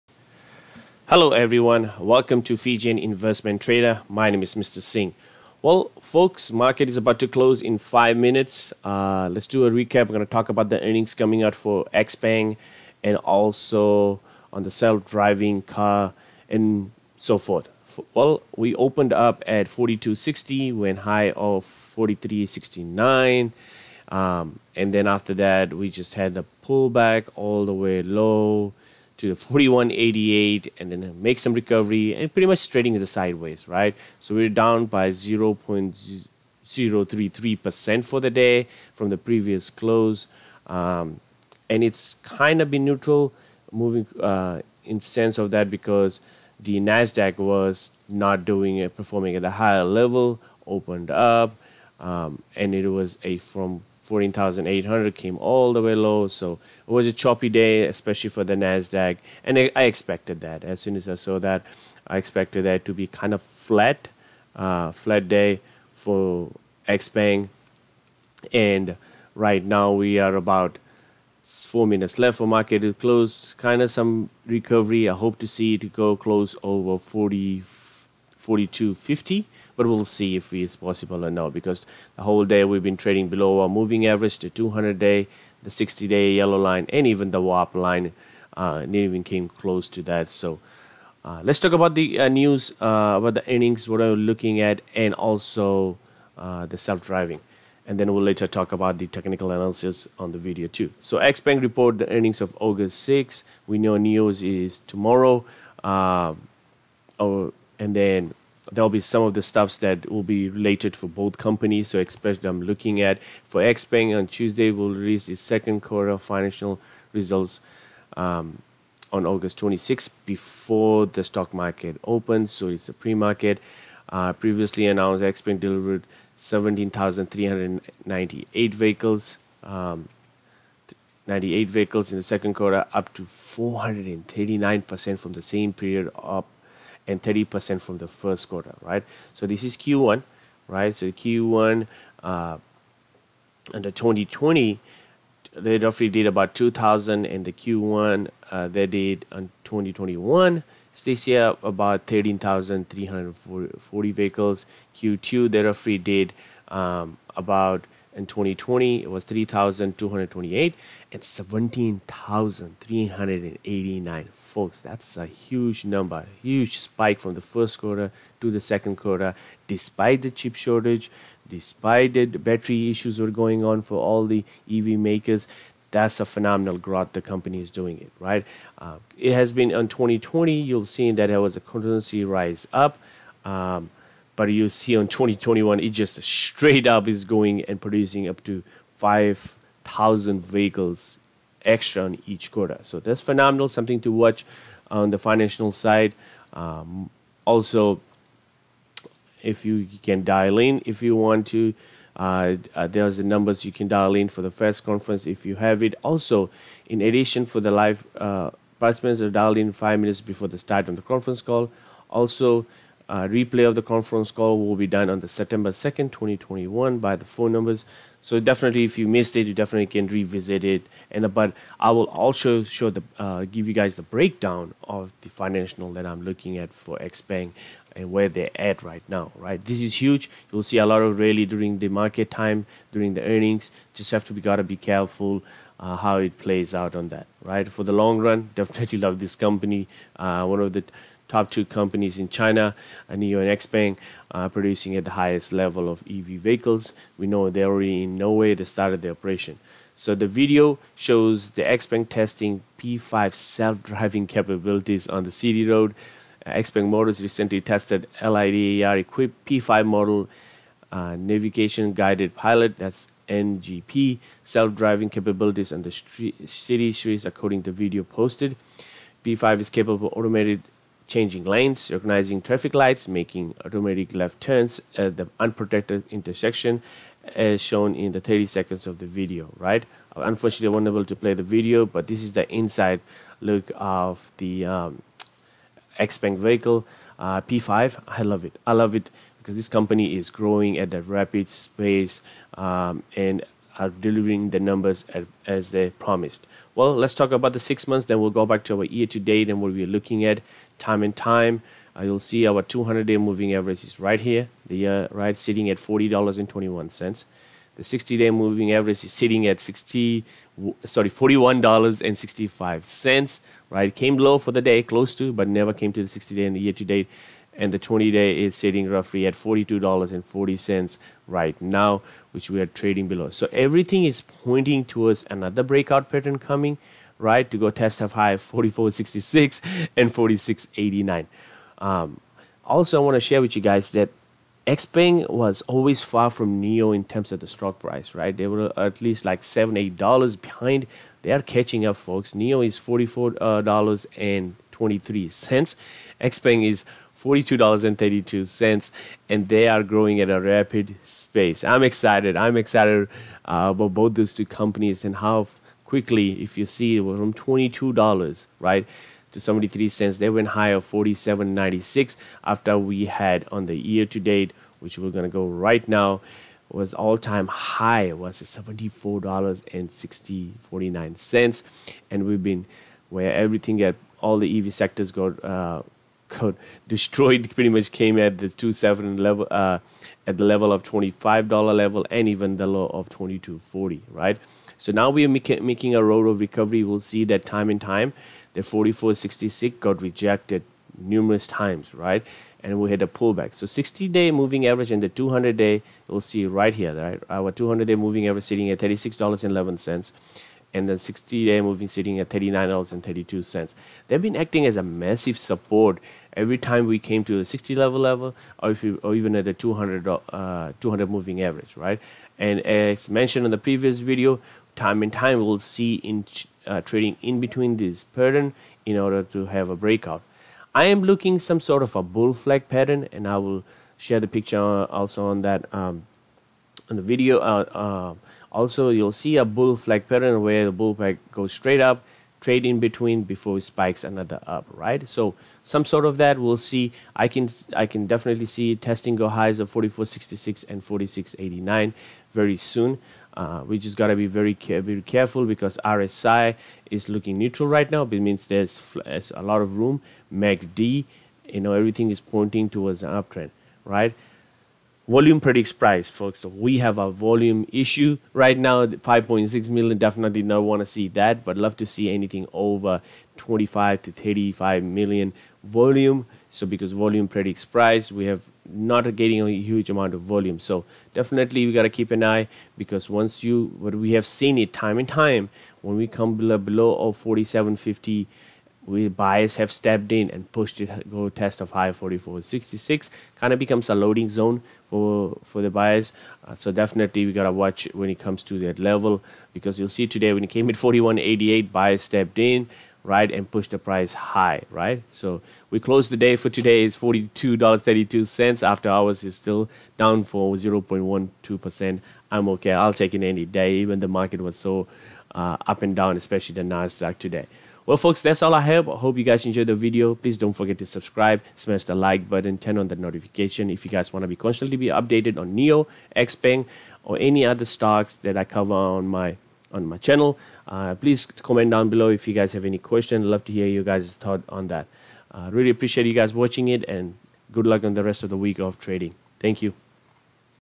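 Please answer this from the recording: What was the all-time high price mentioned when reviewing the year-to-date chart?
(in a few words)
$74.60.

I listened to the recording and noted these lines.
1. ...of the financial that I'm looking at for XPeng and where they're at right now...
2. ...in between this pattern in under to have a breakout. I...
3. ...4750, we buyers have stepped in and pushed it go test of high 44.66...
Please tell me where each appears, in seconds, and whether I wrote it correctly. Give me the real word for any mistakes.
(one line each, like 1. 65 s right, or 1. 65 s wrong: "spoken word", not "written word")
1. 224 s right
2. 417 s wrong: "order", not "under"
3. 477 s right.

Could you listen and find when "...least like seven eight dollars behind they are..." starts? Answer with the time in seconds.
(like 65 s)
339 s.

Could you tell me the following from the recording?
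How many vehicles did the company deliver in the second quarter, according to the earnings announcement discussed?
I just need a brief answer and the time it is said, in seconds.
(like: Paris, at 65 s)
17,398, at 126 s.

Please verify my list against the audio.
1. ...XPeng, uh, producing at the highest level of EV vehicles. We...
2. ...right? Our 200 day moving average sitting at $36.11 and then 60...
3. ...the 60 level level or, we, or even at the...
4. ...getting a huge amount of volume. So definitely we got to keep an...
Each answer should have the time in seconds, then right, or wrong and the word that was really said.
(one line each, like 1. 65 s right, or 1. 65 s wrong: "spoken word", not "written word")
1. 243 s right
2. 396 s right
3. 407 s right
4. 469 s right.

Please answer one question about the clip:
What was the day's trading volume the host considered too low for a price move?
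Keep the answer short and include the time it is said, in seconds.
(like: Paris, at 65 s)
5.6 million, at 458 s.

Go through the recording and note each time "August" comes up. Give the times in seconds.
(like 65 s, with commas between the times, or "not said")
102 s, 119 s.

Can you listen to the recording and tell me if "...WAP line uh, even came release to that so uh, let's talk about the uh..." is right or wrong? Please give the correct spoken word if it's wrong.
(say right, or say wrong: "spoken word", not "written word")
wrong: "close", not "release".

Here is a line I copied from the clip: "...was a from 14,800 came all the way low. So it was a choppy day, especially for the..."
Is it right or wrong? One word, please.
right.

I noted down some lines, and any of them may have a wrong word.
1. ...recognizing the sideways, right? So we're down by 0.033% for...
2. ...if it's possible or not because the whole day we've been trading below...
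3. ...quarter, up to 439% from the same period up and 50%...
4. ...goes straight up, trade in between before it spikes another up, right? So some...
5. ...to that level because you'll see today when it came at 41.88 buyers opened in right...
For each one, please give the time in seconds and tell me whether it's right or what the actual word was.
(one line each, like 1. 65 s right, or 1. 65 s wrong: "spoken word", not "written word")
1. 32 s wrong: "trading", not "recognizing"
2. 80 s right
3. 132 s wrong: "30", not "50"
4. 431 s right
5. 488 s wrong: "stepped", not "opened".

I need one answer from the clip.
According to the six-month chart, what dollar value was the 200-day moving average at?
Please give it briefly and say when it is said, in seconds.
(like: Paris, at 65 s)
$40.21, at 305 s.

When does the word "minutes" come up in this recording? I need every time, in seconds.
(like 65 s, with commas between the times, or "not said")
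8 s, 71 s, 209 s.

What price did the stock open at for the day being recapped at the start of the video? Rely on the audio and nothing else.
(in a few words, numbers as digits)
42.60.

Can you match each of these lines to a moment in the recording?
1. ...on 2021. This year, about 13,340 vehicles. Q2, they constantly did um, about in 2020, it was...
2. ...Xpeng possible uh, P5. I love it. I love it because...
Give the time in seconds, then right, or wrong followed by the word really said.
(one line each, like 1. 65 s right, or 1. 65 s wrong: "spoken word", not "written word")
1. 149 s wrong: "roughly", not "constantly"
2. 285 s wrong: "vehicle", not "possible".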